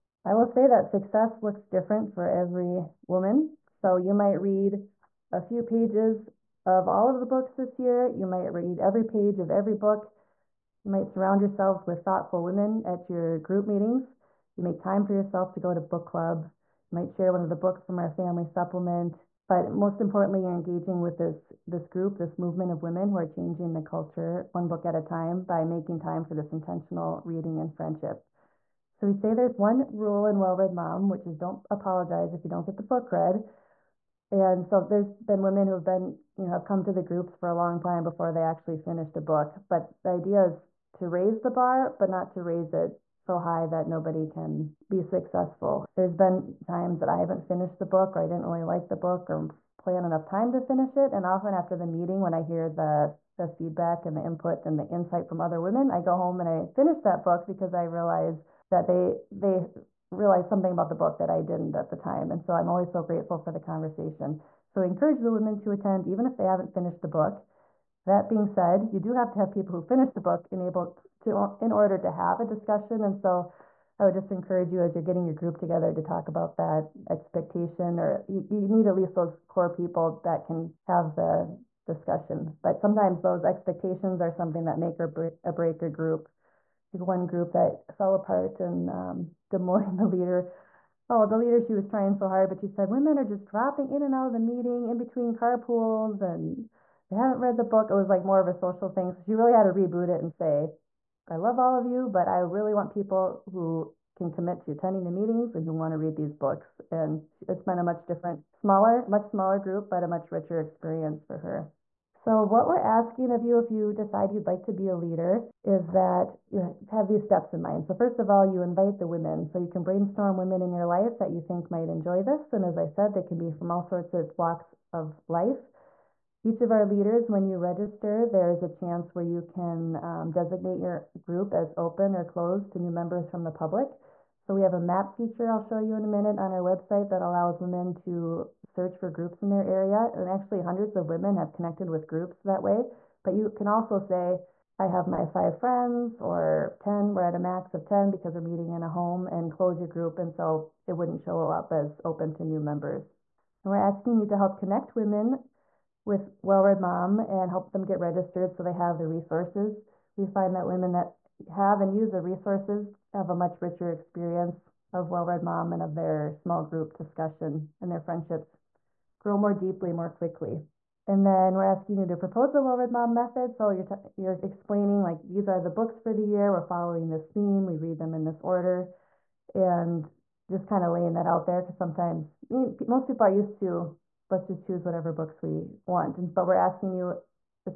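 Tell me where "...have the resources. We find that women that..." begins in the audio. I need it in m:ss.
2:38.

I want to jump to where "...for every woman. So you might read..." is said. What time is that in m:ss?
0:02.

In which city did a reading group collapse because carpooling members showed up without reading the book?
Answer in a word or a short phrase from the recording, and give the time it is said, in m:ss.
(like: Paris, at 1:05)
Des Moines, at 1:29.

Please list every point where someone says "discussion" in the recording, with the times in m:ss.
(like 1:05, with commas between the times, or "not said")
1:12, 1:21, 2:46.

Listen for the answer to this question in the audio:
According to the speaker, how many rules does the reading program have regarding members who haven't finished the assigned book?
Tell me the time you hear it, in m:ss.
0:29.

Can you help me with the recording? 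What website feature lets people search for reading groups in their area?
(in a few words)
map feature.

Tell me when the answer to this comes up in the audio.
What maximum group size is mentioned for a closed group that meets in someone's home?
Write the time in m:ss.
2:27.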